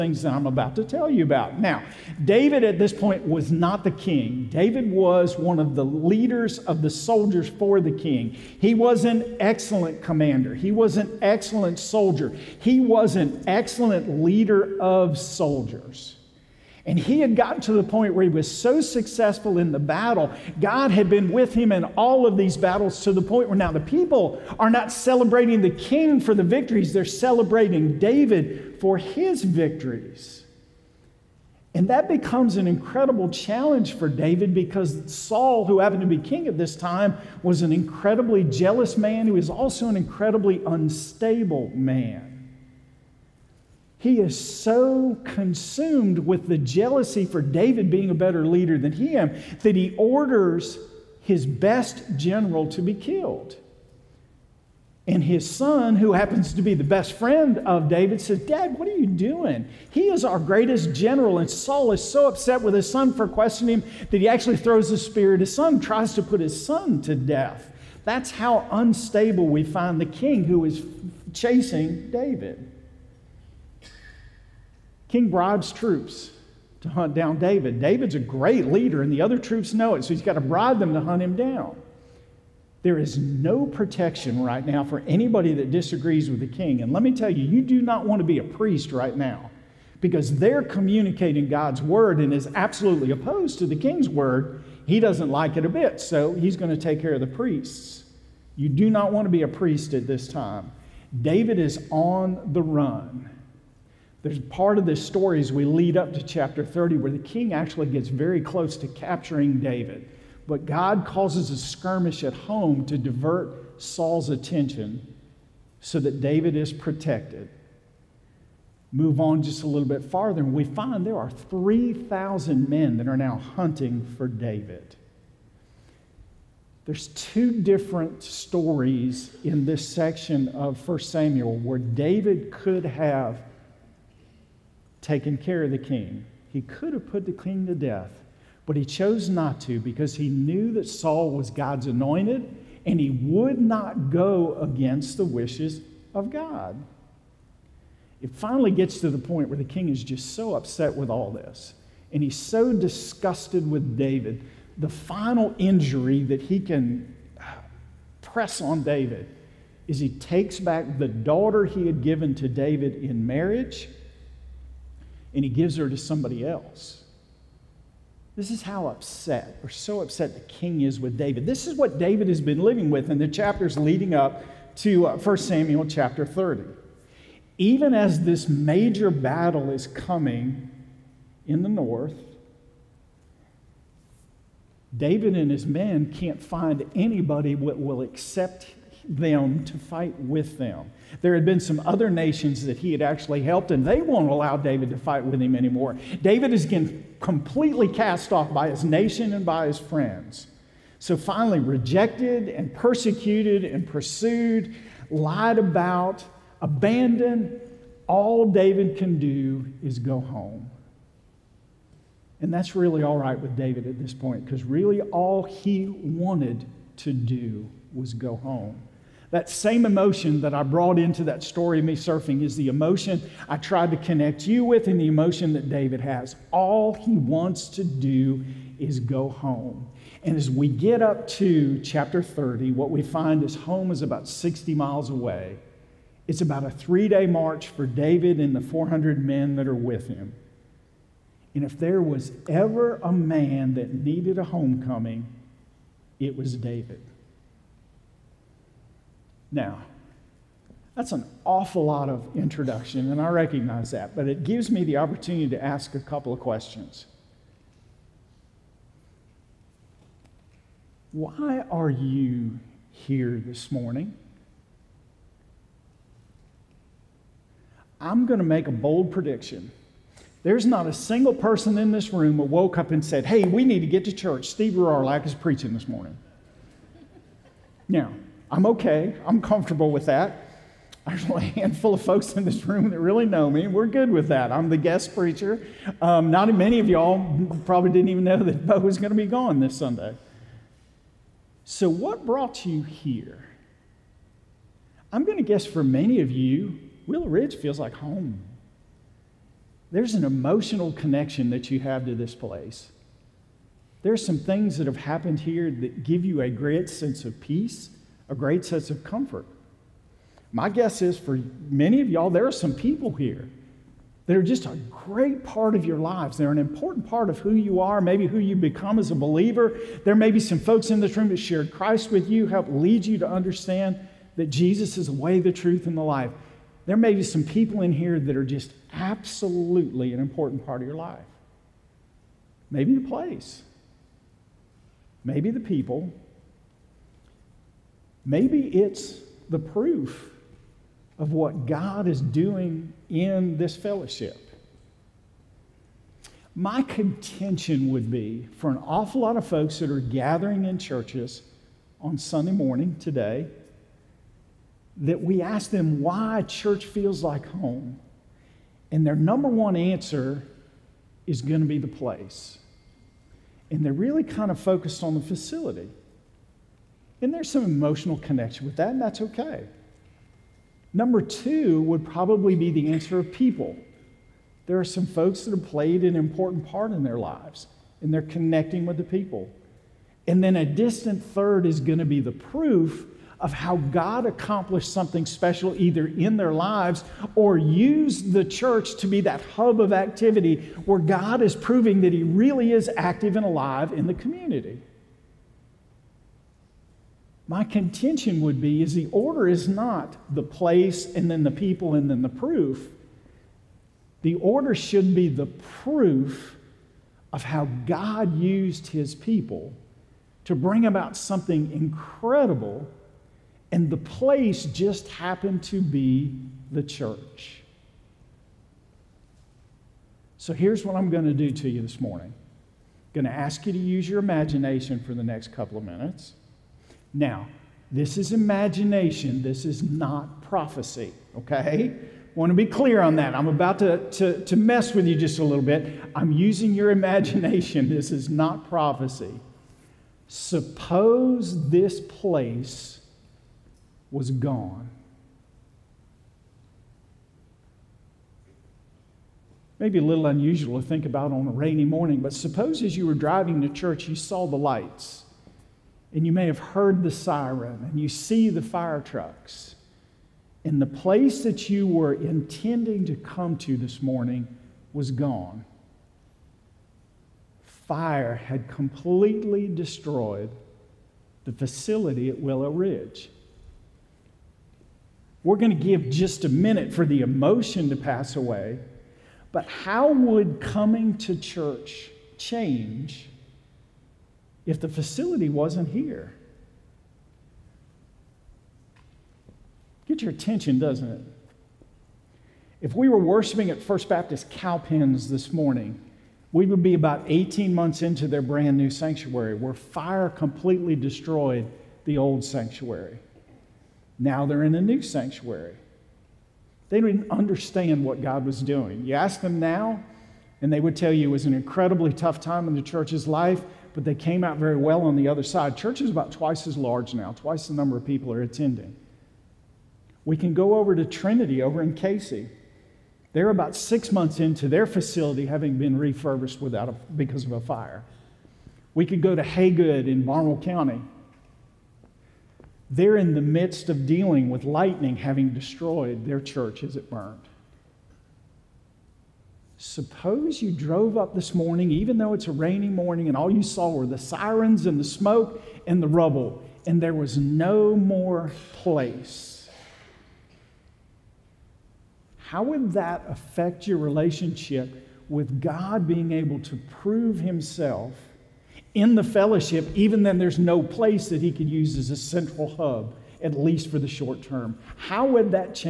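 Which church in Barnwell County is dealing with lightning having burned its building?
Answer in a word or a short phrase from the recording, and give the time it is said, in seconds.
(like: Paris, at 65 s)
Haygood, at 529 s.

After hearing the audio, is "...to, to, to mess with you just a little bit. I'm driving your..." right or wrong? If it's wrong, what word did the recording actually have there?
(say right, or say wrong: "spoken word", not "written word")
wrong: "using", not "driving".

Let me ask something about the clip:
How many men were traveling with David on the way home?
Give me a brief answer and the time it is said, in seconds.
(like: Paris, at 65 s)
400, at 238 s.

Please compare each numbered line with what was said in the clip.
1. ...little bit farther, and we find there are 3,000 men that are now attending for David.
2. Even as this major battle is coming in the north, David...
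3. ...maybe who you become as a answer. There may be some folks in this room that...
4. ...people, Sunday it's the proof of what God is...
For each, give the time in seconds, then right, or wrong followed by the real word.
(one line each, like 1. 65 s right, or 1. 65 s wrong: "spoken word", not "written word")
1. 119 s wrong: "hunting", not "attending"
2. 177 s right
3. 318 s wrong: "believer", not "answer"
4. 335 s wrong: "Maybe", not "Sunday".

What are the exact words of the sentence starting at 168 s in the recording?
This is how upset, or so upset, the king is with David.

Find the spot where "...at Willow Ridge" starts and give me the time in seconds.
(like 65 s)
472 s.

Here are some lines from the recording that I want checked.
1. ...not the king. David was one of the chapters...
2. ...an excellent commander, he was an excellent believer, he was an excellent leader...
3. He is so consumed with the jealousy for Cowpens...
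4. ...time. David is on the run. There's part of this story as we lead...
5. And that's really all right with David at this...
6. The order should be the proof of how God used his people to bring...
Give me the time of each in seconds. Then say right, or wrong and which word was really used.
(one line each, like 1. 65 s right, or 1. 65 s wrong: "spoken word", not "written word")
1. 3 s wrong: "leaders", not "chapters"
2. 9 s wrong: "soldier", not "believer"
3. 43 s wrong: "David", not "Cowpens"
4. 100 s right
5. 212 s right
6. 404 s right.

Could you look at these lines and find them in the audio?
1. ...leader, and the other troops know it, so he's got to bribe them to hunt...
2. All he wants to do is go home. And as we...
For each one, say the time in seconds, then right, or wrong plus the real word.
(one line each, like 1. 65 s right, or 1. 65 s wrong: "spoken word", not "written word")
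1. 78 s right
2. 226 s right.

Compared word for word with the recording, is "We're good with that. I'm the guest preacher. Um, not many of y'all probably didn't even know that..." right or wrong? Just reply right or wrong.
right.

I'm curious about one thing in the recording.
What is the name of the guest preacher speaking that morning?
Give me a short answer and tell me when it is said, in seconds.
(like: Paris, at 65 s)
Steve Rohrlack, at 274 s.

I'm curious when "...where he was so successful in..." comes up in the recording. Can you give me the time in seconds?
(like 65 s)
18 s.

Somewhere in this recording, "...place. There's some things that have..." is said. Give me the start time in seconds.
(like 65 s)
302 s.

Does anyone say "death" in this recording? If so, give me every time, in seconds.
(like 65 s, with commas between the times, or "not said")
67 s, 137 s.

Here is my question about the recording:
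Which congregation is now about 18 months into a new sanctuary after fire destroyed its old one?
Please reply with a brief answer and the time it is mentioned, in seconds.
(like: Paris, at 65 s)
First Baptist Cowpens, at 493 s.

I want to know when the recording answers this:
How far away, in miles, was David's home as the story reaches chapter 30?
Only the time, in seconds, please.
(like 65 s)
234 s.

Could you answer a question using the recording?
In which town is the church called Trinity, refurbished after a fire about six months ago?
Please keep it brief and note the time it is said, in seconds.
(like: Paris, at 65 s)
Cayce, at 521 s.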